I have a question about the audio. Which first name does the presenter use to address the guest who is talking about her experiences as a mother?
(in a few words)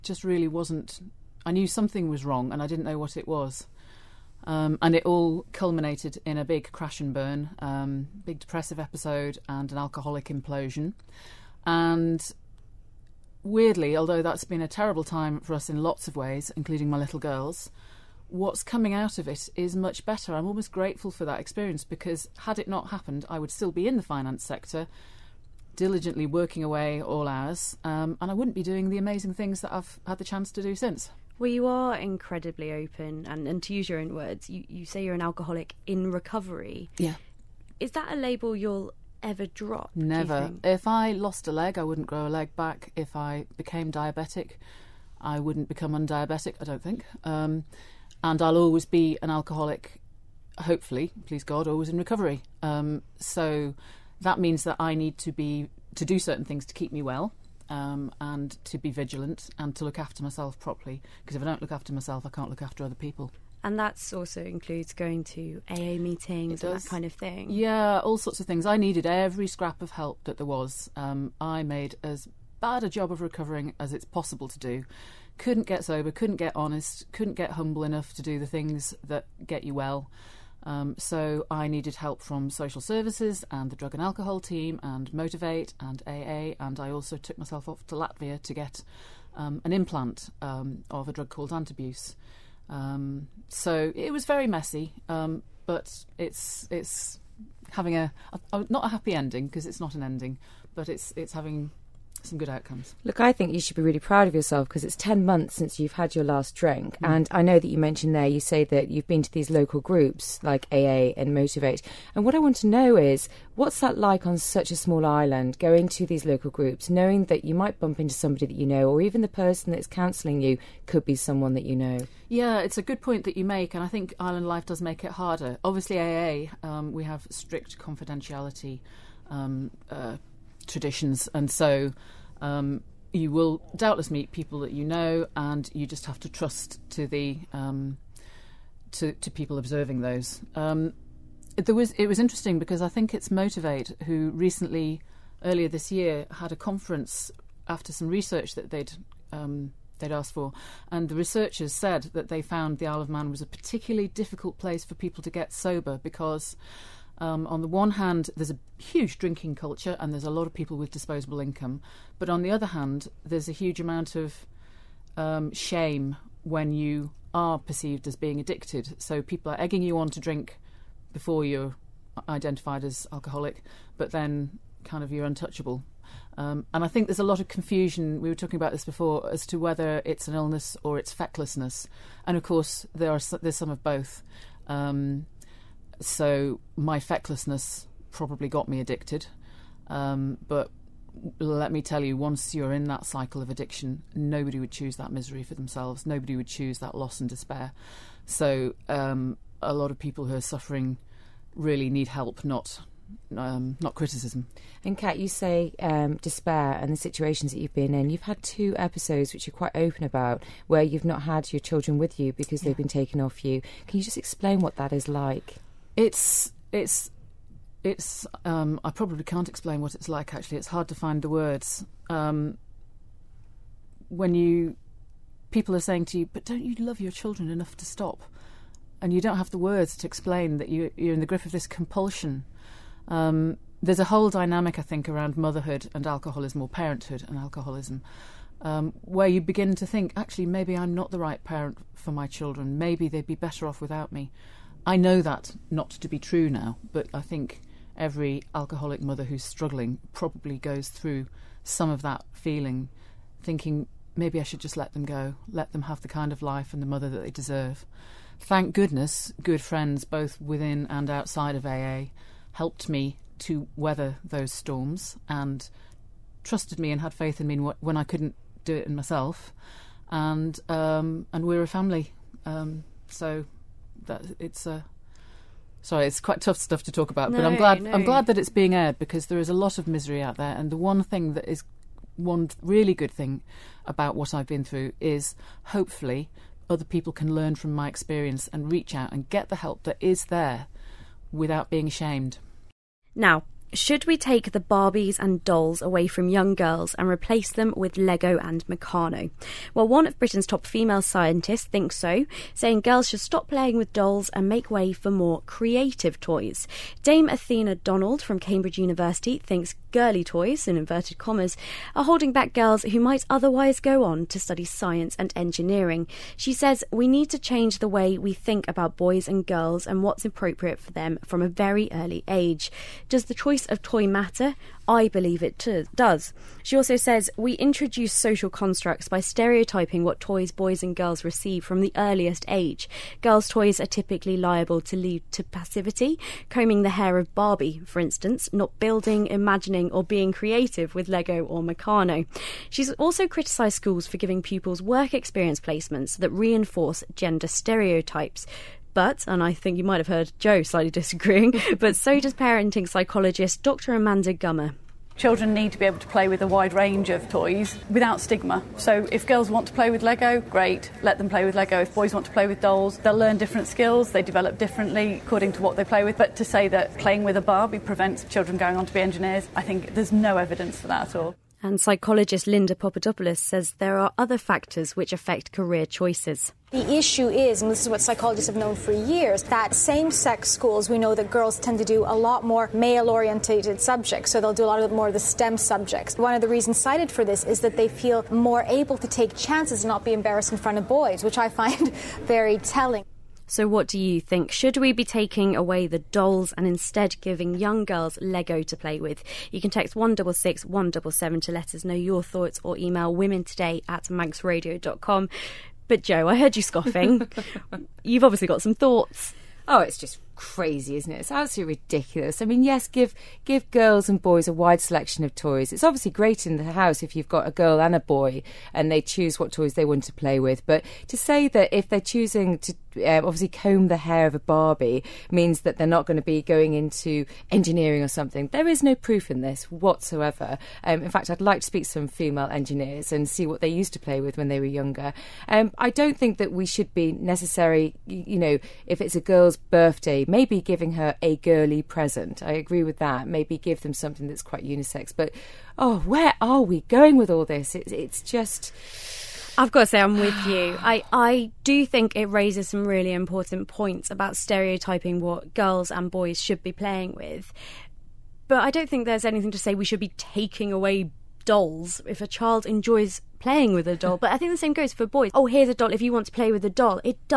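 Kat.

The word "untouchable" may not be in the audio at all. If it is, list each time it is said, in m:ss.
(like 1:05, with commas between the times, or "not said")
2:55.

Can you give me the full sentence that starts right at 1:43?
Look, I think you should be really proud of yourself because it's 10 months since you've had your last drink.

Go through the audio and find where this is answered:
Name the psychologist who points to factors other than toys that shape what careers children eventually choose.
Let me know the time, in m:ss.
6:12.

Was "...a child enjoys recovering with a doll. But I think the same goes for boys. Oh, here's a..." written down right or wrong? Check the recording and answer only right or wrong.
wrong.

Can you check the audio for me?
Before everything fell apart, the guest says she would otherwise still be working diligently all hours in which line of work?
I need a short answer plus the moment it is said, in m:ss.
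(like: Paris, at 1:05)
finance sector, at 0:24.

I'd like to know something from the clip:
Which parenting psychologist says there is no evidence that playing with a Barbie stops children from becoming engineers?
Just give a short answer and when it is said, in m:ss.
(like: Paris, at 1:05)
Dr. Amanda Gummer, at 5:53.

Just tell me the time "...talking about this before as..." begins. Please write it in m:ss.
2:58.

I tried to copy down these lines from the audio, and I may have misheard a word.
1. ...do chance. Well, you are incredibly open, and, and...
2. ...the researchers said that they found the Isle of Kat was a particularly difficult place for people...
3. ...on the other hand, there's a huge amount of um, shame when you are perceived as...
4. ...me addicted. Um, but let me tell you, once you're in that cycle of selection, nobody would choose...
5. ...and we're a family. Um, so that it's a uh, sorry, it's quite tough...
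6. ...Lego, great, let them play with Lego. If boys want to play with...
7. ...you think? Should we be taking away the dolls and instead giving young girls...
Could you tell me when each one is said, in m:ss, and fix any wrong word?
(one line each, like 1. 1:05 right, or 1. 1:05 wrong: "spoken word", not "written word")
1. 0:30 wrong: "since", not "chance"
2. 2:31 wrong: "Man", not "Kat"
3. 2:42 right
4. 3:08 wrong: "addiction", not "selection"
5. 4:31 right
6. 6:00 right
7. 6:33 right.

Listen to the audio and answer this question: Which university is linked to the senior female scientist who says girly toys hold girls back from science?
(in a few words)
Cambridge University.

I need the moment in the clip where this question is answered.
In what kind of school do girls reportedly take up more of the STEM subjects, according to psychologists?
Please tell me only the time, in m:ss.
6:19.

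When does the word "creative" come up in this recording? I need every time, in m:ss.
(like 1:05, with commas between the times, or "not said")
5:05, 5:40.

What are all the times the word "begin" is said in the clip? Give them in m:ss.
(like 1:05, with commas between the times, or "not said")
3:59.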